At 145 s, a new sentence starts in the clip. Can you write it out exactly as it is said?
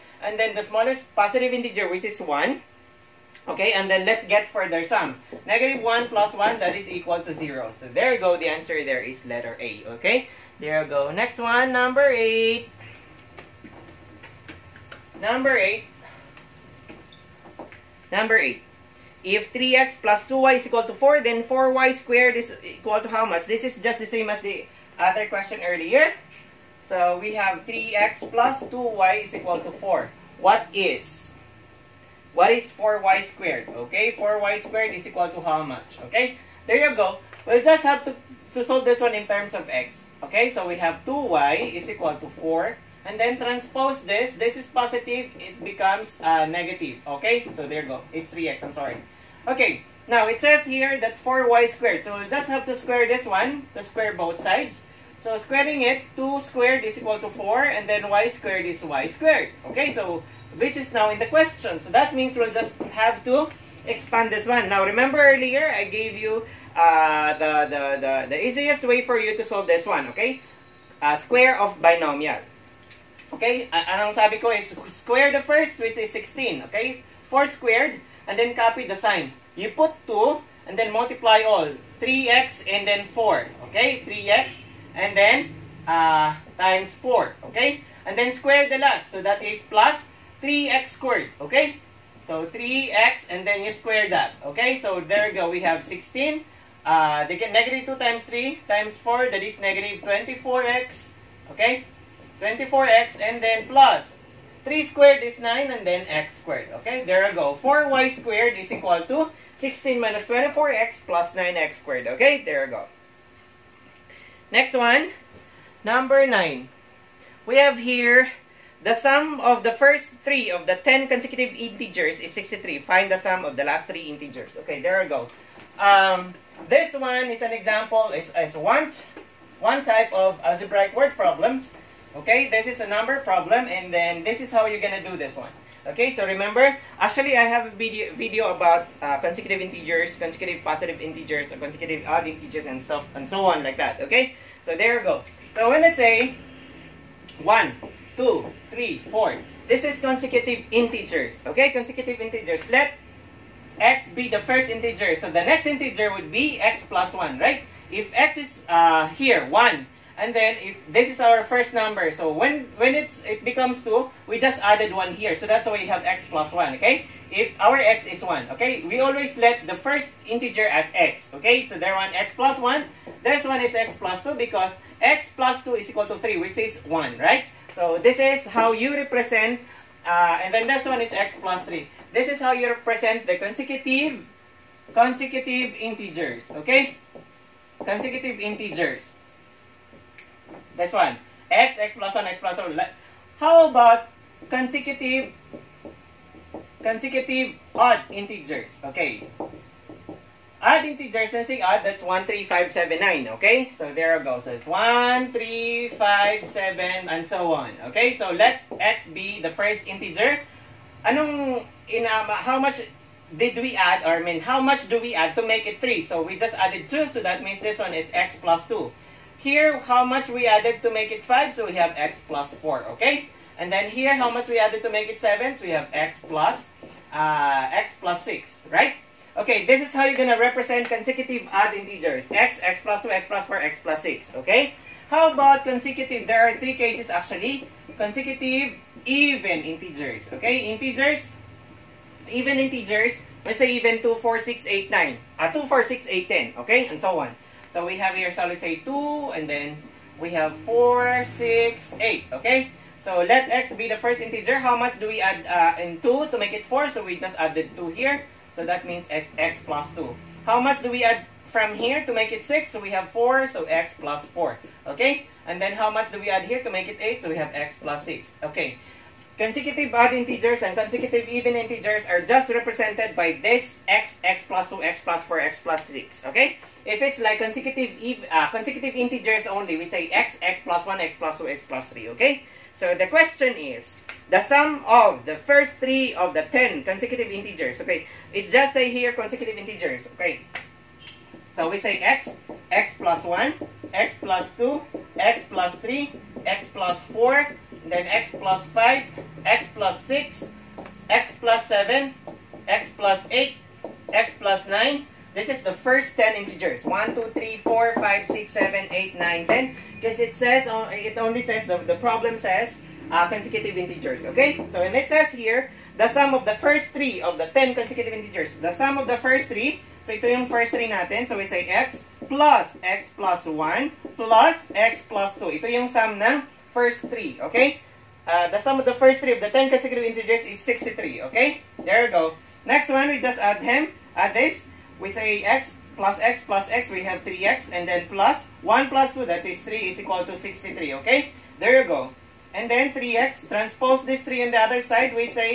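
So when I say 1, Two, three, four.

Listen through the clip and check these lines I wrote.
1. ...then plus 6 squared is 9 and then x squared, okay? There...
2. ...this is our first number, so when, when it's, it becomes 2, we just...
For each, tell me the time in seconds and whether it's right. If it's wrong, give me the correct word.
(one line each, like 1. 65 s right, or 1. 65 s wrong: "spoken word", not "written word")
1. 103 s wrong: "3", not "6"
2. 160 s right.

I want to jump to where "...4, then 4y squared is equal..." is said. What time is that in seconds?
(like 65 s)
20 s.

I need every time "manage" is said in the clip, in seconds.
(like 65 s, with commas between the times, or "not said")
not said.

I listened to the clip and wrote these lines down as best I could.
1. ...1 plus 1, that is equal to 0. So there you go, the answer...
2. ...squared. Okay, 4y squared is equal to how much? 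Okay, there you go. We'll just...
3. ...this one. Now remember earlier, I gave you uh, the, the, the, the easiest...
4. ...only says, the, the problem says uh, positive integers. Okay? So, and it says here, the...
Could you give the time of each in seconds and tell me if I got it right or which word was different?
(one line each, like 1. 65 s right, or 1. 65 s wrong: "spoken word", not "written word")
1. 5 s right
2. 33 s right
3. 64 s right
4. 311 s wrong: "consecutive", not "positive".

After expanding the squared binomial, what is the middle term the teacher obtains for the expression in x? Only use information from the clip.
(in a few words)
-24x.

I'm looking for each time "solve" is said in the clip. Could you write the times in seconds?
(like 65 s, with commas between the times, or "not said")
38 s, 69 s.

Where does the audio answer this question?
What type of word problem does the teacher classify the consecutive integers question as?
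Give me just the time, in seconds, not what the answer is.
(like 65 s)
132 s.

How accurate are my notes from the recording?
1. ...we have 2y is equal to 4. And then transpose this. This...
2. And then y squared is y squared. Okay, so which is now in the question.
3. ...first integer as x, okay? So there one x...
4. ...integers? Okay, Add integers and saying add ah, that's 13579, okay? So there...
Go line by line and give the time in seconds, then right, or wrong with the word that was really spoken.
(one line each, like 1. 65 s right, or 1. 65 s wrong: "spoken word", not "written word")
1. 40 s right
2. 57 s right
3. 169 s right
4. 198 s right.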